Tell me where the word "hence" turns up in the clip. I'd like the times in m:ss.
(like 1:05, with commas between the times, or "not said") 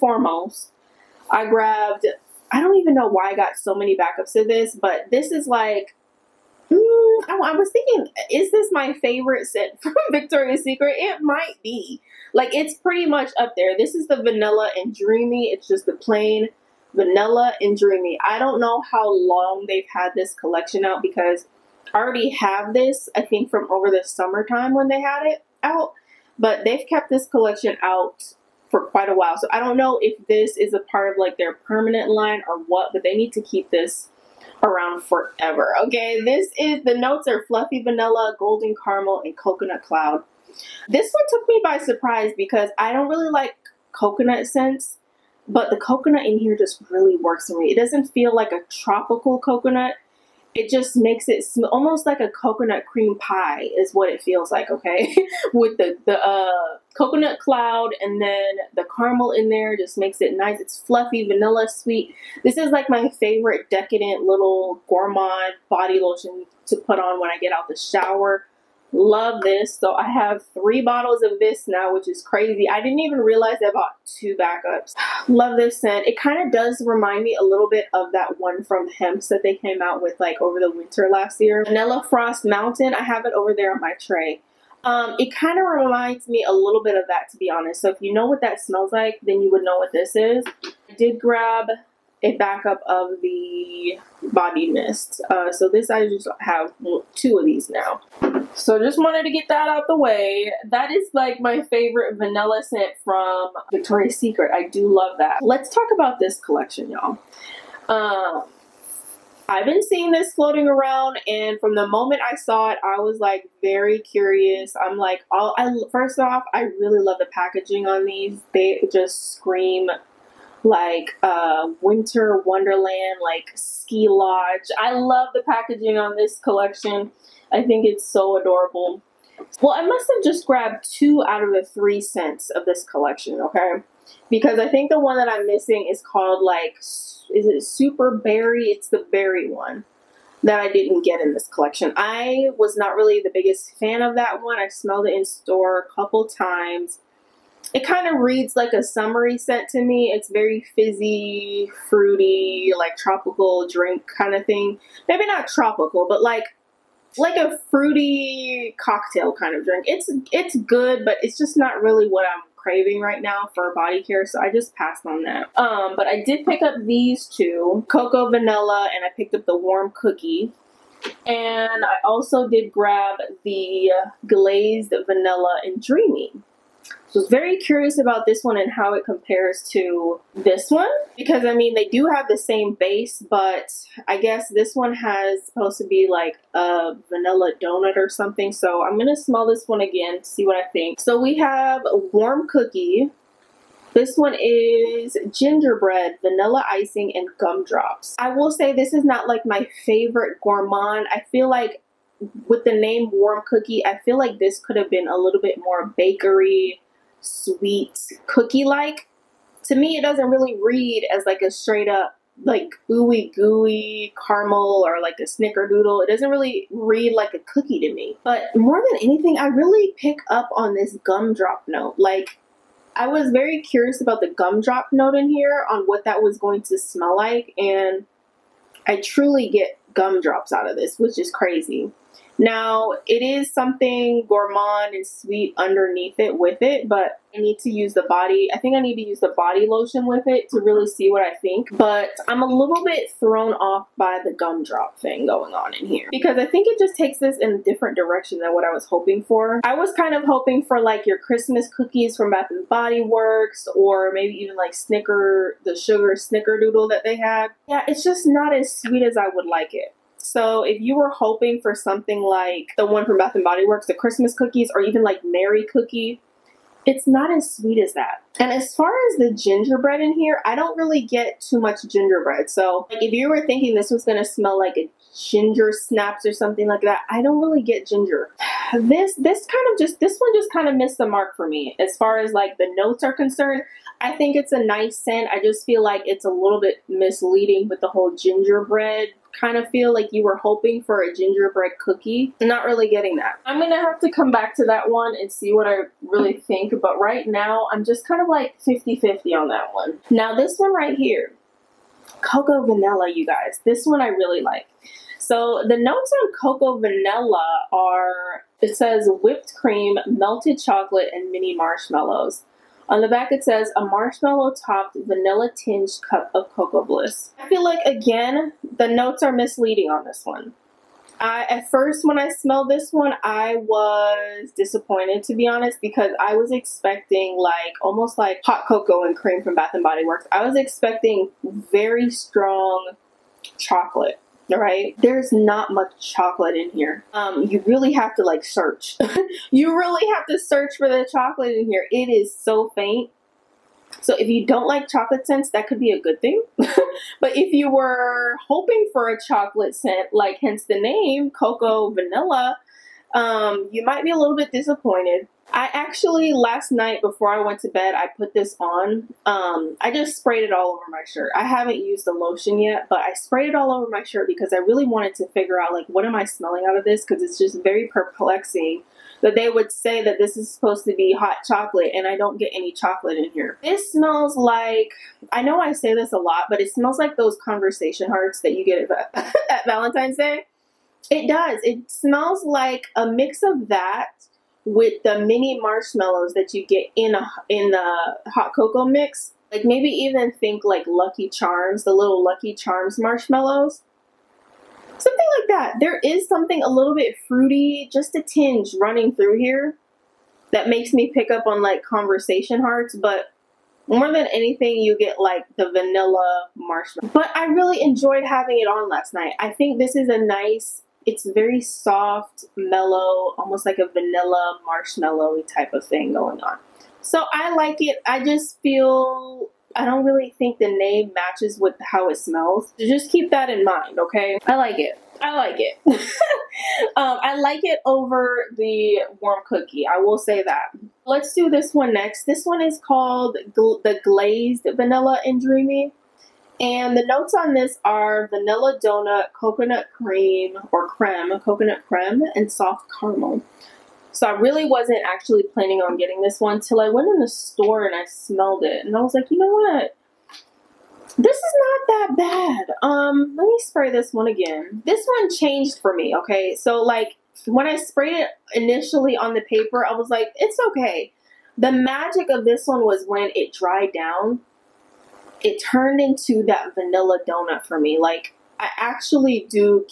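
5:50.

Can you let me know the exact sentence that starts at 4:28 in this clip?
And as far as the gingerbread in here, I don't really get too much gingerbread.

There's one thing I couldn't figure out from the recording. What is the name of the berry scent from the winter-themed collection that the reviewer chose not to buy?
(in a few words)
Super Berry.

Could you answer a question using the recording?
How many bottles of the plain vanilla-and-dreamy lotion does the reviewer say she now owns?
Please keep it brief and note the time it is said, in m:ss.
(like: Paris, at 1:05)
3, at 1:10.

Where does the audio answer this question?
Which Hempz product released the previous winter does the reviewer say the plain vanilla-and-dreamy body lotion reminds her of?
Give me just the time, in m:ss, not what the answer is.
1:21.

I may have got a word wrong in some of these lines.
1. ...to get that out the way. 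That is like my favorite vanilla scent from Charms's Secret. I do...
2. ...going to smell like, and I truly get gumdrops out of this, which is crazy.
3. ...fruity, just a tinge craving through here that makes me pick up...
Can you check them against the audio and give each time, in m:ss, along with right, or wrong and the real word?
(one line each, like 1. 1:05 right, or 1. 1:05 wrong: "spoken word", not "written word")
1. 1:39 wrong: "Victoria", not "Charms"
2. 3:46 right
3. 6:37 wrong: "running", not "craving".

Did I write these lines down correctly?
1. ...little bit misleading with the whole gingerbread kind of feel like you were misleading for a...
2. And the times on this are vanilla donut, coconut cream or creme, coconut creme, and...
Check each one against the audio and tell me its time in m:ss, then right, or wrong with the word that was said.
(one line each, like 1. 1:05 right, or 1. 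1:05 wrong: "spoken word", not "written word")
1. 4:46 wrong: "hoping", not "misleading"
2. 7:16 wrong: "notes", not "times".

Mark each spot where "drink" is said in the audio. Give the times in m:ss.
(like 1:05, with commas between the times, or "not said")
2:33, 2:39.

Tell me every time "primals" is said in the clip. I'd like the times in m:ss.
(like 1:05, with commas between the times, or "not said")
not said.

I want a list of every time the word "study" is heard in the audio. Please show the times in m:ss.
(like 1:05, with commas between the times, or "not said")
not said.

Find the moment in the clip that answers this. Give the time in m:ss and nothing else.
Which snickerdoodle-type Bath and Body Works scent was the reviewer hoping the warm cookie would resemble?
4:15.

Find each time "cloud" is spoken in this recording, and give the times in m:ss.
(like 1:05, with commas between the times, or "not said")
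0:39, 0:57.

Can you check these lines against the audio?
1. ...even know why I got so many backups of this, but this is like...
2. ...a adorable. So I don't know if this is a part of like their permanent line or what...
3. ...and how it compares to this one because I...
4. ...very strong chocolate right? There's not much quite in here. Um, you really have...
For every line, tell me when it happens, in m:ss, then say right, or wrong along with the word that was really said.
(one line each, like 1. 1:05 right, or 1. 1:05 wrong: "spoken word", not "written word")
1. 0:02 right
2. 0:29 wrong: "while", not "adorable"
3. 2:58 right
4. 5:31 wrong: "chocolate", not "quite".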